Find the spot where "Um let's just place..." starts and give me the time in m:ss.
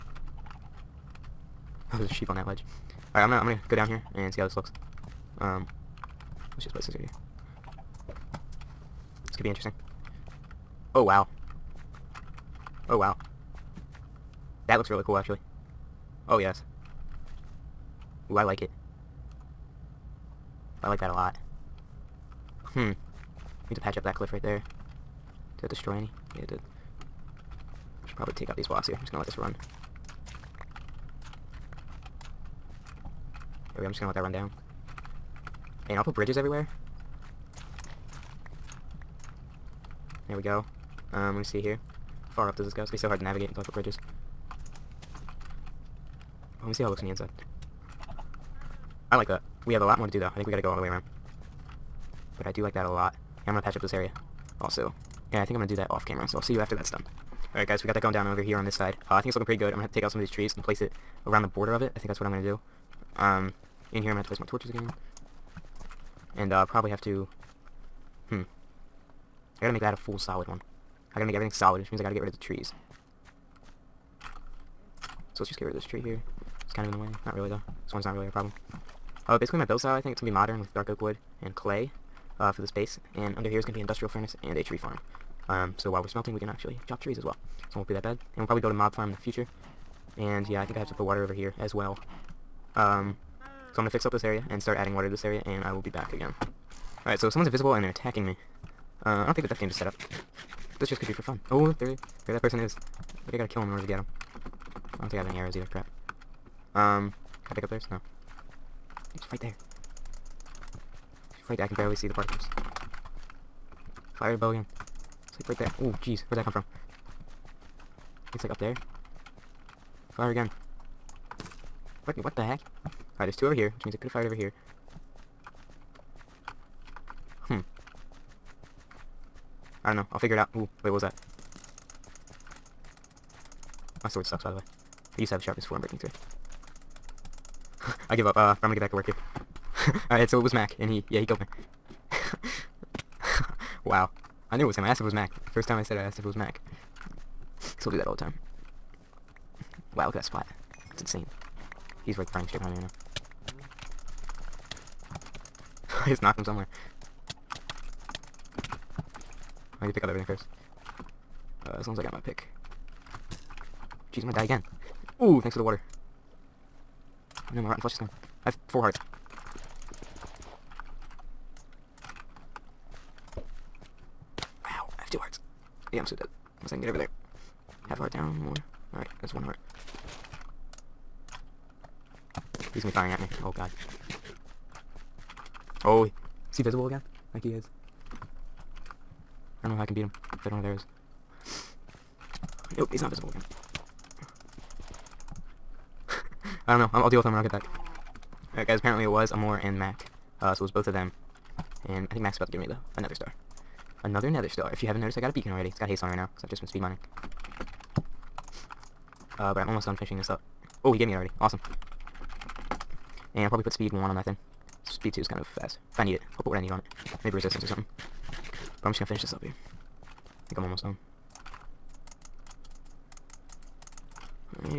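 0:05.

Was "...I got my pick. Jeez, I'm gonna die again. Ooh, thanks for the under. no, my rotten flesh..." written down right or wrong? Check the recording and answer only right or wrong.
wrong.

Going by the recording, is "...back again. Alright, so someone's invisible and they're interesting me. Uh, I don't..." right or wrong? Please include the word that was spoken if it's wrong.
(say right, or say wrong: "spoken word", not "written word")
wrong: "attacking", not "interesting".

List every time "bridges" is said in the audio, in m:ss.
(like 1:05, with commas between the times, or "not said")
0:36, 0:43.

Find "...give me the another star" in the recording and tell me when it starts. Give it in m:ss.
3:22.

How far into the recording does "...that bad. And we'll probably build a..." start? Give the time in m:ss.
1:27.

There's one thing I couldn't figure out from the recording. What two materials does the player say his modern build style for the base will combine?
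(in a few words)
Dark oak wood and clay.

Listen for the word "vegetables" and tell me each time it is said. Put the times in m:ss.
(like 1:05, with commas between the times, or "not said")
not said.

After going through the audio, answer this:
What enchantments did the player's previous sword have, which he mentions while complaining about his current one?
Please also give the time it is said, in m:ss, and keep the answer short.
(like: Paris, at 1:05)
Sharpness 4, Unbreaking 3, at 2:15.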